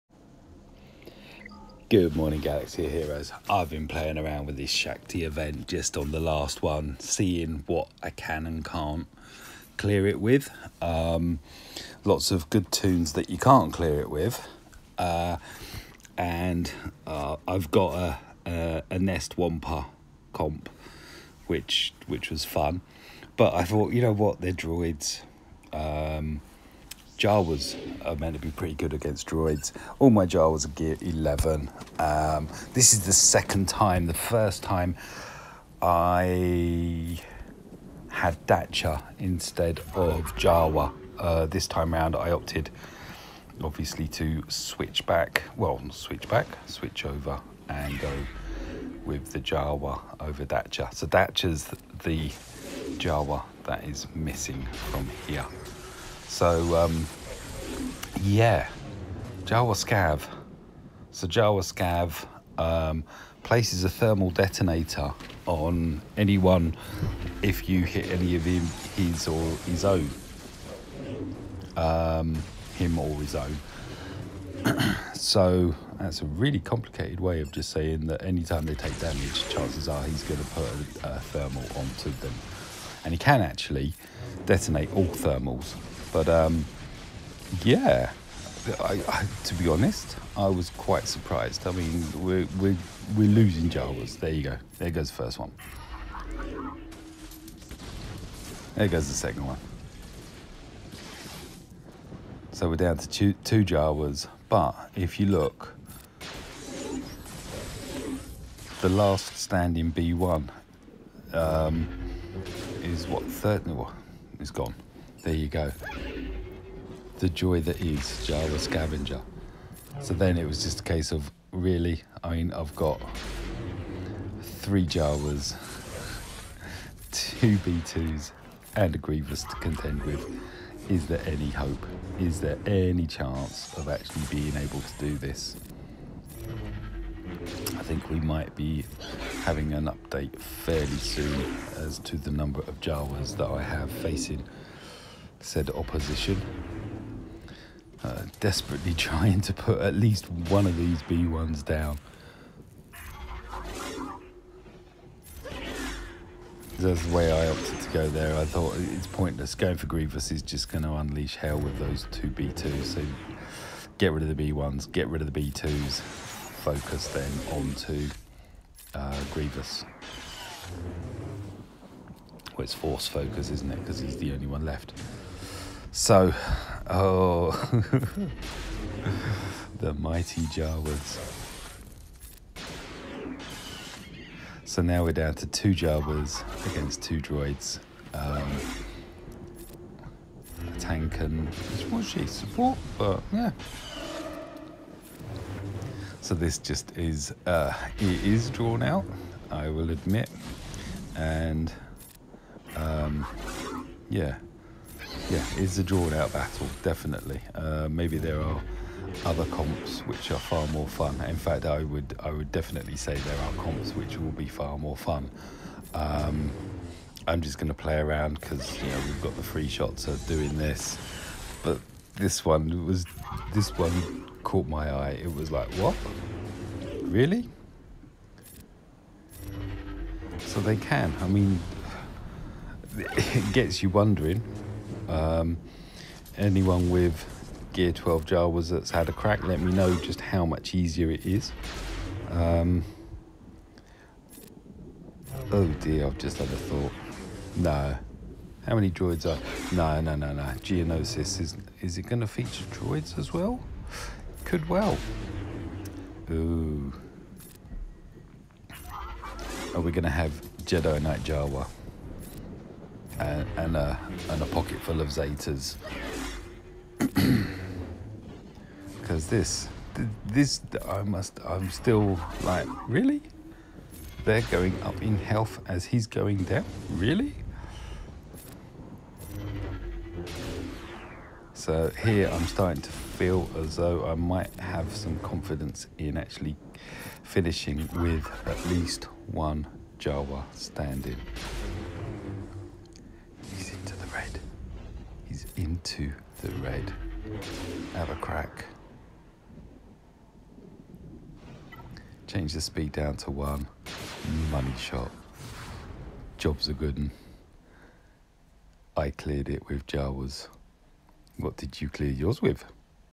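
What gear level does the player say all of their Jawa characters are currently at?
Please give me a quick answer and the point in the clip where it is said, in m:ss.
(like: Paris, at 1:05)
Gear 11, at 0:30.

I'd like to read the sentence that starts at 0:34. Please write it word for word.
The first time I had Dathcha instead of Jawa.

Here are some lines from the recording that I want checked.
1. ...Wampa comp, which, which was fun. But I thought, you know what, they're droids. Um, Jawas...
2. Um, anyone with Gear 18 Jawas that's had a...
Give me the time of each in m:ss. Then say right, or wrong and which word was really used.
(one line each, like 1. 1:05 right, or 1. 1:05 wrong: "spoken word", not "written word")
1. 0:19 right
2. 3:55 wrong: "12", not "18".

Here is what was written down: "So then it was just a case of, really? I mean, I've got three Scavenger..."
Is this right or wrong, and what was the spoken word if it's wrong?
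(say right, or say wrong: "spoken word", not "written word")
wrong: "Jawas", not "Scavenger".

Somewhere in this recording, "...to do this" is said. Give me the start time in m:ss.
2:14.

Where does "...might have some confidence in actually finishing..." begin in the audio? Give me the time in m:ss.
4:44.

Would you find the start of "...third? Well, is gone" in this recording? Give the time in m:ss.
1:53.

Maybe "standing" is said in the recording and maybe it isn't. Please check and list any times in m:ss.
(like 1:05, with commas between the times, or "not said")
1:49, 4:50.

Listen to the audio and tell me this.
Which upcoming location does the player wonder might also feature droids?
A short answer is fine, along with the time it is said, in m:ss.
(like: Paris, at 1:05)
Geonosis, at 4:10.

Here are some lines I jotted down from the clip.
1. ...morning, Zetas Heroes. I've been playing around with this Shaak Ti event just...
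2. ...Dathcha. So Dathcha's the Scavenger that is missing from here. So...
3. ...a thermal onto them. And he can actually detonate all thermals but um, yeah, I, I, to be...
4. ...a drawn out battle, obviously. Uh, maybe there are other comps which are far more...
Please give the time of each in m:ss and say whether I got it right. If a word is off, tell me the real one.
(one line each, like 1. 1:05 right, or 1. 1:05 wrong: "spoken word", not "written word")
1. 0:02 wrong: "Galaxy", not "Zetas"
2. 0:50 wrong: "Jawa", not "Scavenger"
3. 1:21 right
4. 3:25 wrong: "definitely", not "obviously".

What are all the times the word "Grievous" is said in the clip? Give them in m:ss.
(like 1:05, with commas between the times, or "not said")
2:08, 2:39, 2:49.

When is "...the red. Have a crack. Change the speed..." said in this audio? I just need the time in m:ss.
4:56.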